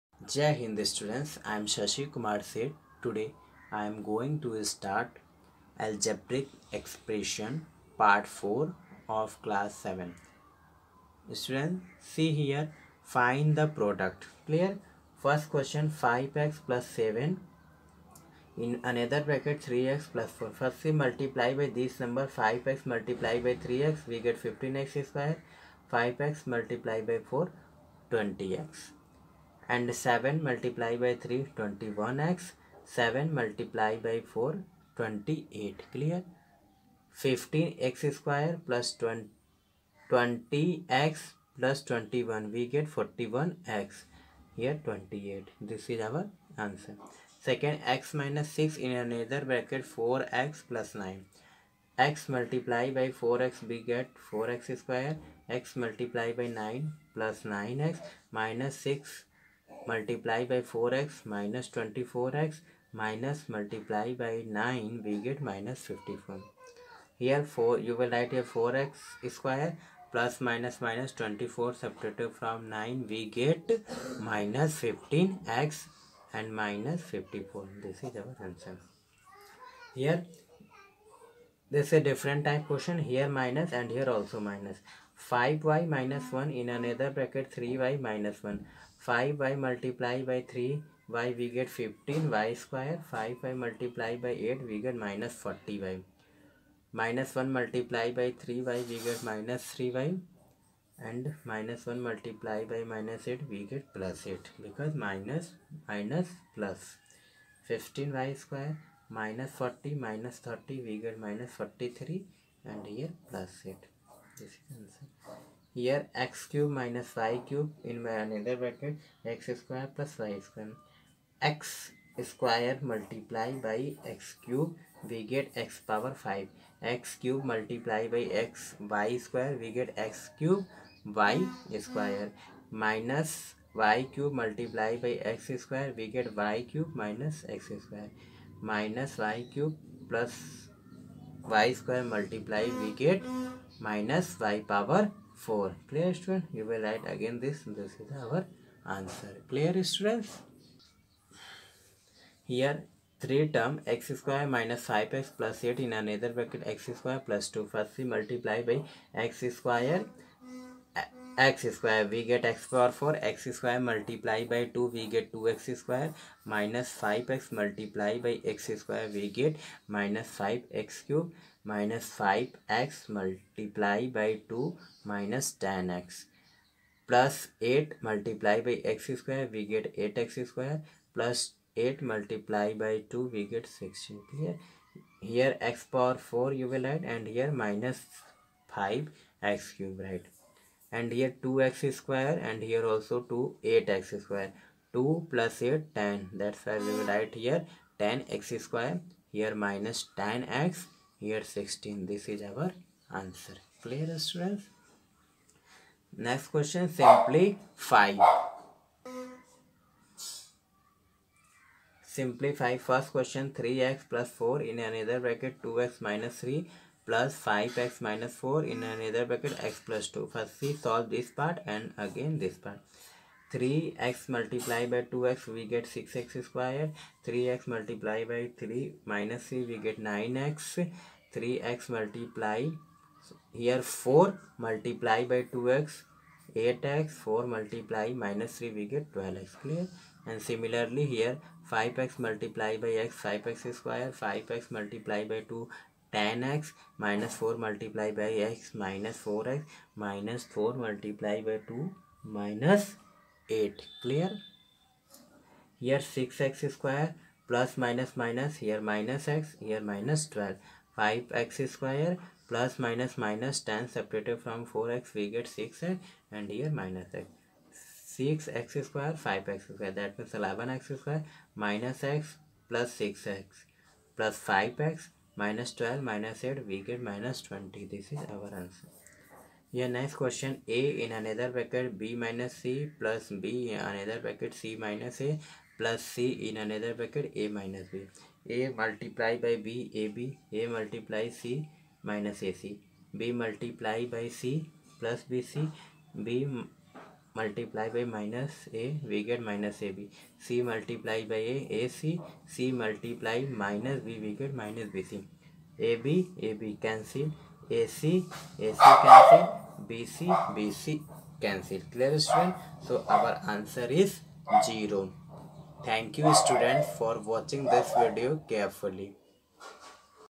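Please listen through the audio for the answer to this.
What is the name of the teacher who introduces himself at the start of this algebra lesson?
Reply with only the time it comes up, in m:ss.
0:01.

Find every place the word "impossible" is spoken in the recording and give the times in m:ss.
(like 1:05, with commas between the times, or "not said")
not said.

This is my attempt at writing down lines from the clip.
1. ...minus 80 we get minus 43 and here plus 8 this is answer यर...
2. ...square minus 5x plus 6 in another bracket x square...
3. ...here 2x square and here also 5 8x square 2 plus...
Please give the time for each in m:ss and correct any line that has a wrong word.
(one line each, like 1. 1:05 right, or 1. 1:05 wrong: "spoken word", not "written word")
1. 1:50 wrong: "30", not "80"
2. 2:34 wrong: "8", not "6"
3. 3:11 wrong: "2", not "5".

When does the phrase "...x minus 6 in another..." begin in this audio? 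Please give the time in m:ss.
0:47.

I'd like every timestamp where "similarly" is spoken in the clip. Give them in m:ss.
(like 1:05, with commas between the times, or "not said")
4:00.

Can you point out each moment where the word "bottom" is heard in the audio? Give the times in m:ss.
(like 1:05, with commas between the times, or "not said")
not said.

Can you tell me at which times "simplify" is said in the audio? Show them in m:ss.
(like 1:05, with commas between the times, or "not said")
3:26, 3:32.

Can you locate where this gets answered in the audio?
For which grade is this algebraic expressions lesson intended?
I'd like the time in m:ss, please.
0:09.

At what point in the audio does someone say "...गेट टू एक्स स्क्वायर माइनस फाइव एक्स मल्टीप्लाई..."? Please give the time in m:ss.
2:45.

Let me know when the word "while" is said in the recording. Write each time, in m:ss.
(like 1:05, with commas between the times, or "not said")
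not said.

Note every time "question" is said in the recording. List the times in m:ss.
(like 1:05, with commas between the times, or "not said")
0:15, 1:22, 3:26, 3:33.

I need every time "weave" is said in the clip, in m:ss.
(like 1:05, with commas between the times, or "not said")
not said.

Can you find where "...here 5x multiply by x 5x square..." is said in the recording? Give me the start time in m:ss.
4:01.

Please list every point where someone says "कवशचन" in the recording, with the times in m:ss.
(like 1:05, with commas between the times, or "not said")
4:40.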